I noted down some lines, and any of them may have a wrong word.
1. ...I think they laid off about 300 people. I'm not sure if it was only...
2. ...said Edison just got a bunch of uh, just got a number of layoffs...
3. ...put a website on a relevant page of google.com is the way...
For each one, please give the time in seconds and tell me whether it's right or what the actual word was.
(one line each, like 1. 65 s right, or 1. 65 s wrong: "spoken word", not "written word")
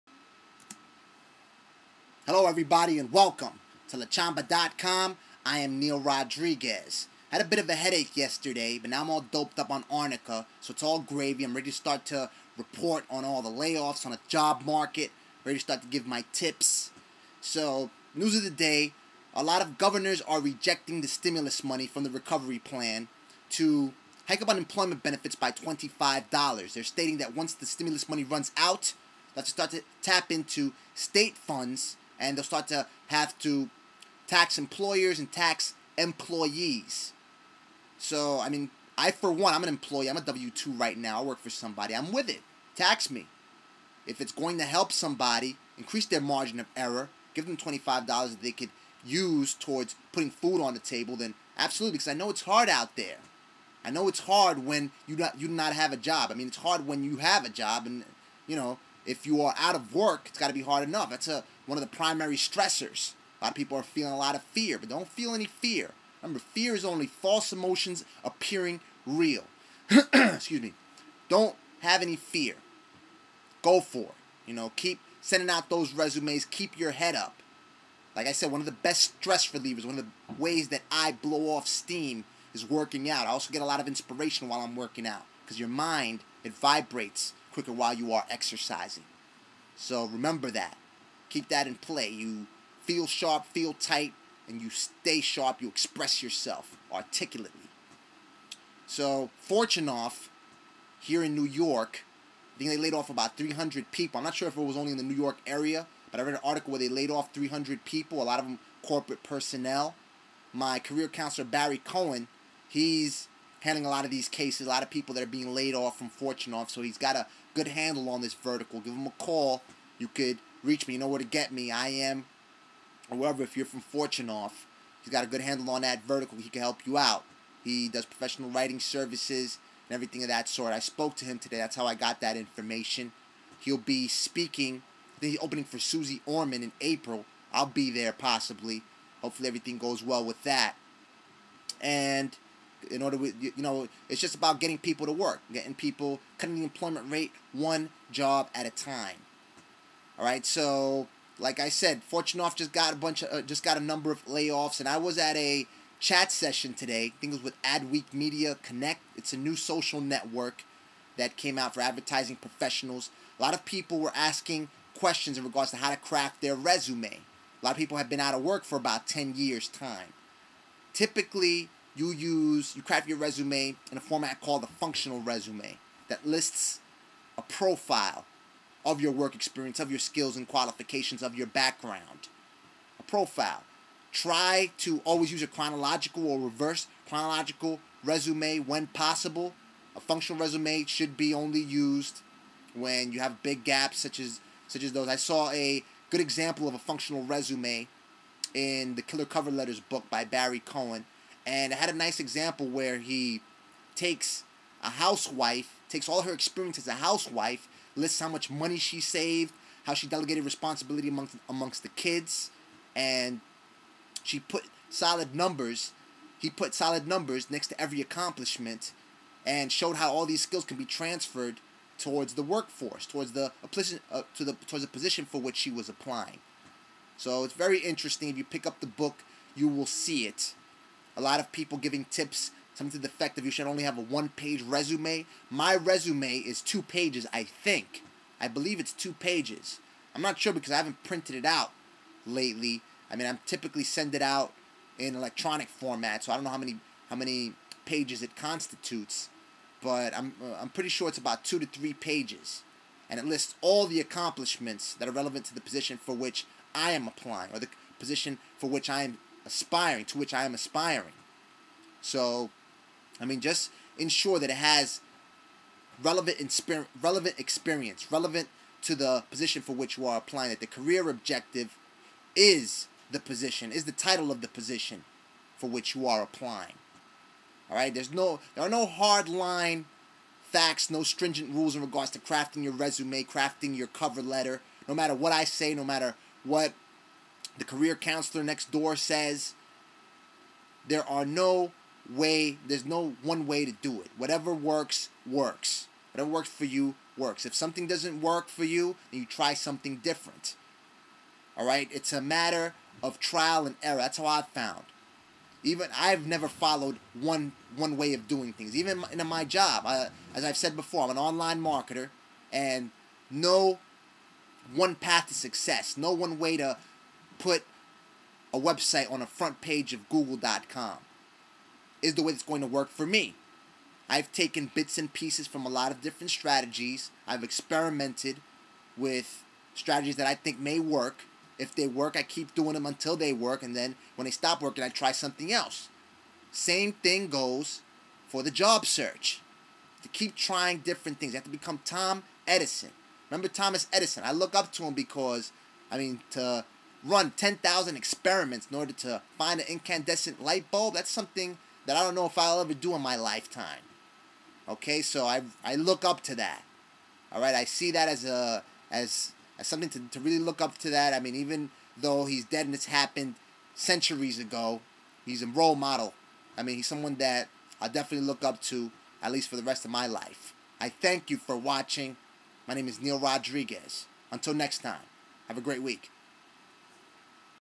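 1. 102 s right
2. 151 s wrong: "Fortunoff", not "Edison"
3. 317 s wrong: "front", not "relevant".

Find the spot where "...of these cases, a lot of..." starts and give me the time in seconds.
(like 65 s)
114 s.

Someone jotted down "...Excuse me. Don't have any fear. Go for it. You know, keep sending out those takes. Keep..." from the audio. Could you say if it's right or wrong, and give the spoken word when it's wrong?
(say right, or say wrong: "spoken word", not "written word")
wrong: "resumes", not "takes".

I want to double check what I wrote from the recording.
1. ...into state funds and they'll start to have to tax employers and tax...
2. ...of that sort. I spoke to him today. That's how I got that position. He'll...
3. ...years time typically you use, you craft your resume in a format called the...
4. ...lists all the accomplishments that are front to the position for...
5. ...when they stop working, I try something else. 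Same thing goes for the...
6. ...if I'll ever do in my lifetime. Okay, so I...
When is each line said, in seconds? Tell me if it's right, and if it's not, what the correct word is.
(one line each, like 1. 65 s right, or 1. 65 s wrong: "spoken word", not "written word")
1. 30 s right
2. 130 s wrong: "information", not "position"
3. 169 s right
4. 253 s wrong: "relevant", not "front"
5. 334 s right
6. 352 s right.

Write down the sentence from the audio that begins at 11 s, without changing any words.
I'm ready to start to report on all the layoffs on the job market, ready to start to give my tips.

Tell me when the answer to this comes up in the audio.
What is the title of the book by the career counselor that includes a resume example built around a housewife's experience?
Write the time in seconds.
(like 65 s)
199 s.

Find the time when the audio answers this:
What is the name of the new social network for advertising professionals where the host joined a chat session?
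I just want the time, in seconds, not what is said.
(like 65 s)
157 s.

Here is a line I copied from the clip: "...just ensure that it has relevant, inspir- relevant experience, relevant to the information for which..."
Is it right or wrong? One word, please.
wrong.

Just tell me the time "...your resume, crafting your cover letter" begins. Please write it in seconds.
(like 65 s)
282 s.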